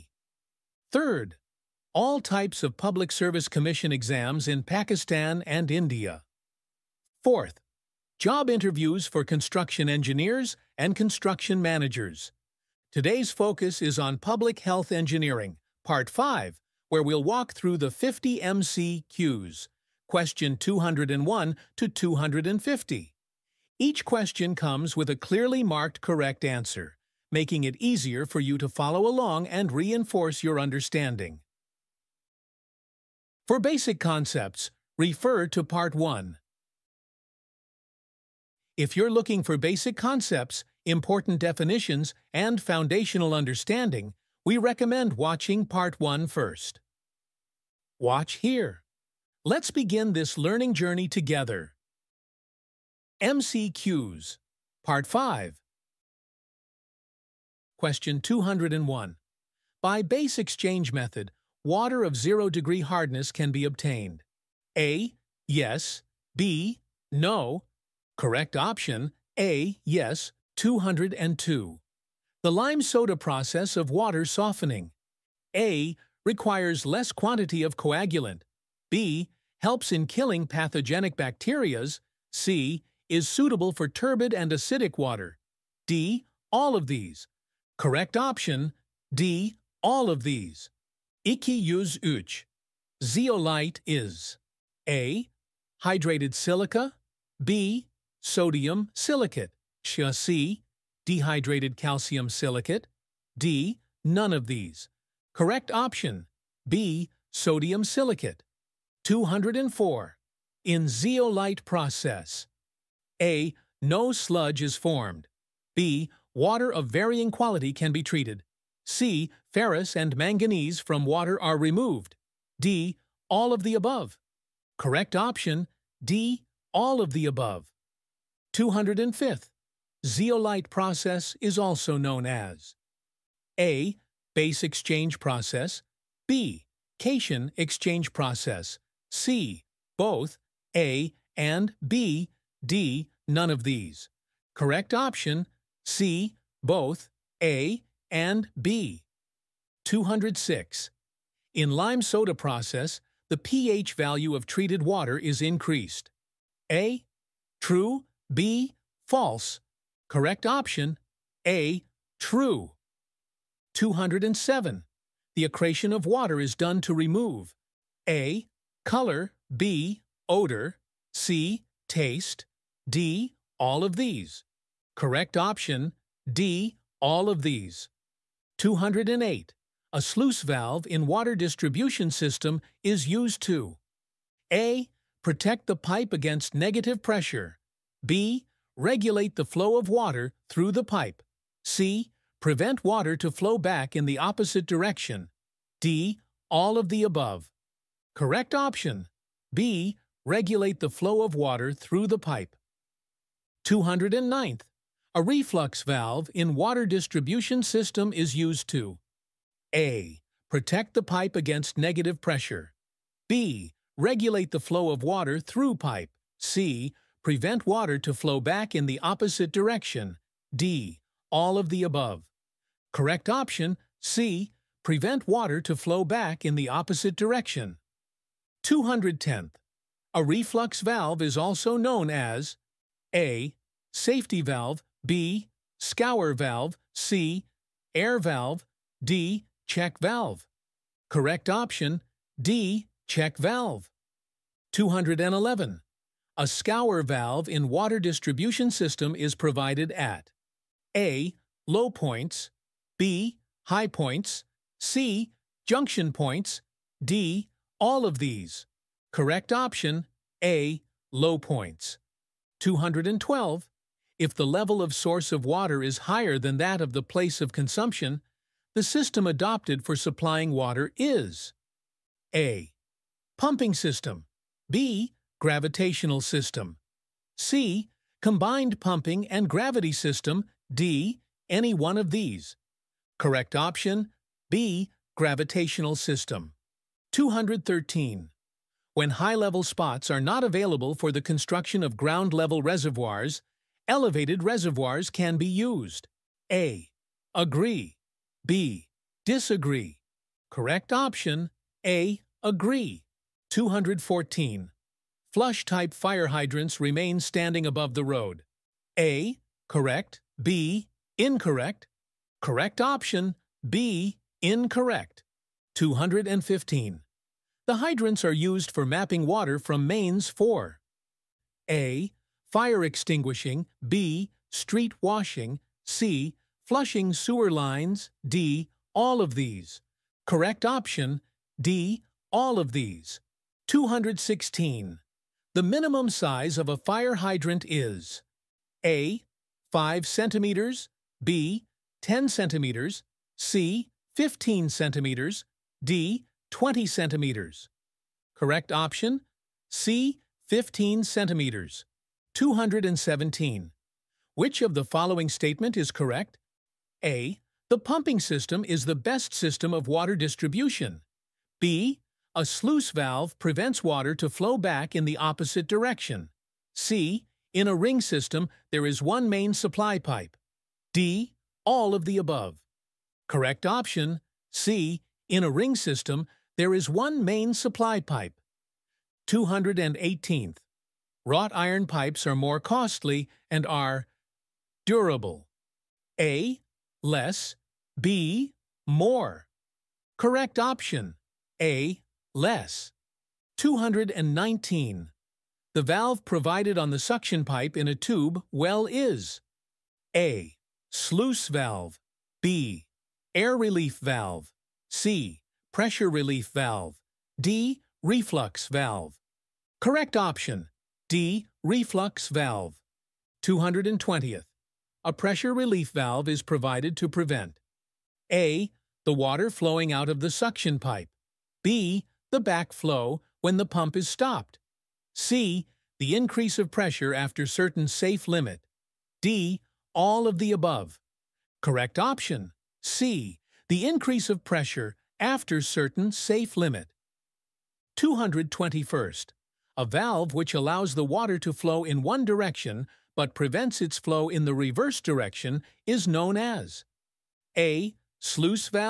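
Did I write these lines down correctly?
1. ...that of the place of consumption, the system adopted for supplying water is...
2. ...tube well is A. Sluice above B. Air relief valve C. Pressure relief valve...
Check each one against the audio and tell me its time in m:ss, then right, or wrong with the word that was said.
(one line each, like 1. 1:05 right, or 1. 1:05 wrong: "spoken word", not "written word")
1. 4:26 right
2. 6:37 wrong: "valve", not "above".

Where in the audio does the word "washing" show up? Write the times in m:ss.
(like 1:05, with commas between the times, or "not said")
5:24.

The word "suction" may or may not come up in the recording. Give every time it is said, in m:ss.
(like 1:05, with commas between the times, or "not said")
6:36, 7:00.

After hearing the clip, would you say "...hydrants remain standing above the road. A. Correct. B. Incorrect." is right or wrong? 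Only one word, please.
right.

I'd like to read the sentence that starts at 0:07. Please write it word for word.
Fourth, job interviews for construction engineers and construction managers.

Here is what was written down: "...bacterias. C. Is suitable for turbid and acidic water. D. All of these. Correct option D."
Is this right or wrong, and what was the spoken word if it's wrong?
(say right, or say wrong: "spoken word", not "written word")
right.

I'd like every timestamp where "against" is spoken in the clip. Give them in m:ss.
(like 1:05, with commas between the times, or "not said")
3:06, 3:31.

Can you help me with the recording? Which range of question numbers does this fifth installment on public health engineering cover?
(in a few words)
201 to 250.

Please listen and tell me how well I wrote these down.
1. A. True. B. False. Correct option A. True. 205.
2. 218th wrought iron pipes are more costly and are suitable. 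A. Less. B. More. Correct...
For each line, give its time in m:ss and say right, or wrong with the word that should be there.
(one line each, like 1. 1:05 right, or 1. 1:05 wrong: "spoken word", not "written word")
1. 2:36 wrong: "207", not "205"
2. 6:19 wrong: "durable", not "suitable".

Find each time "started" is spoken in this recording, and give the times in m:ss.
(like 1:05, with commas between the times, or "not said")
not said.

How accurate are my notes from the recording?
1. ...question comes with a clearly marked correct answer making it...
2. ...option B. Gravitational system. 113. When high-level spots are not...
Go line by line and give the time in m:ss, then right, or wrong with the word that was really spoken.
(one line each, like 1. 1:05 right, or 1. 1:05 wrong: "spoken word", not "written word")
1. 0:24 right
2. 4:43 wrong: "213", not "113".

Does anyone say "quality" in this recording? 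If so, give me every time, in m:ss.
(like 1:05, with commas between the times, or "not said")
1:57.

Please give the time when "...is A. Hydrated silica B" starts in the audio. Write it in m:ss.
1:33.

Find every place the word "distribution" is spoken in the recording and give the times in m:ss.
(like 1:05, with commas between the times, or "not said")
3:01, 3:26, 4:07, 6:00.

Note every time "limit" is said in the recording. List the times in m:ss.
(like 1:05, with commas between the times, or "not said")
7:08, 7:16.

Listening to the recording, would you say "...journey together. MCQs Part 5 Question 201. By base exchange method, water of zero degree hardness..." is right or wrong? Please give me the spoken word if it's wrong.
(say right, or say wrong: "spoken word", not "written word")
right.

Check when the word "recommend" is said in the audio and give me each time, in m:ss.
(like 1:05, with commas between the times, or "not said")
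0:44.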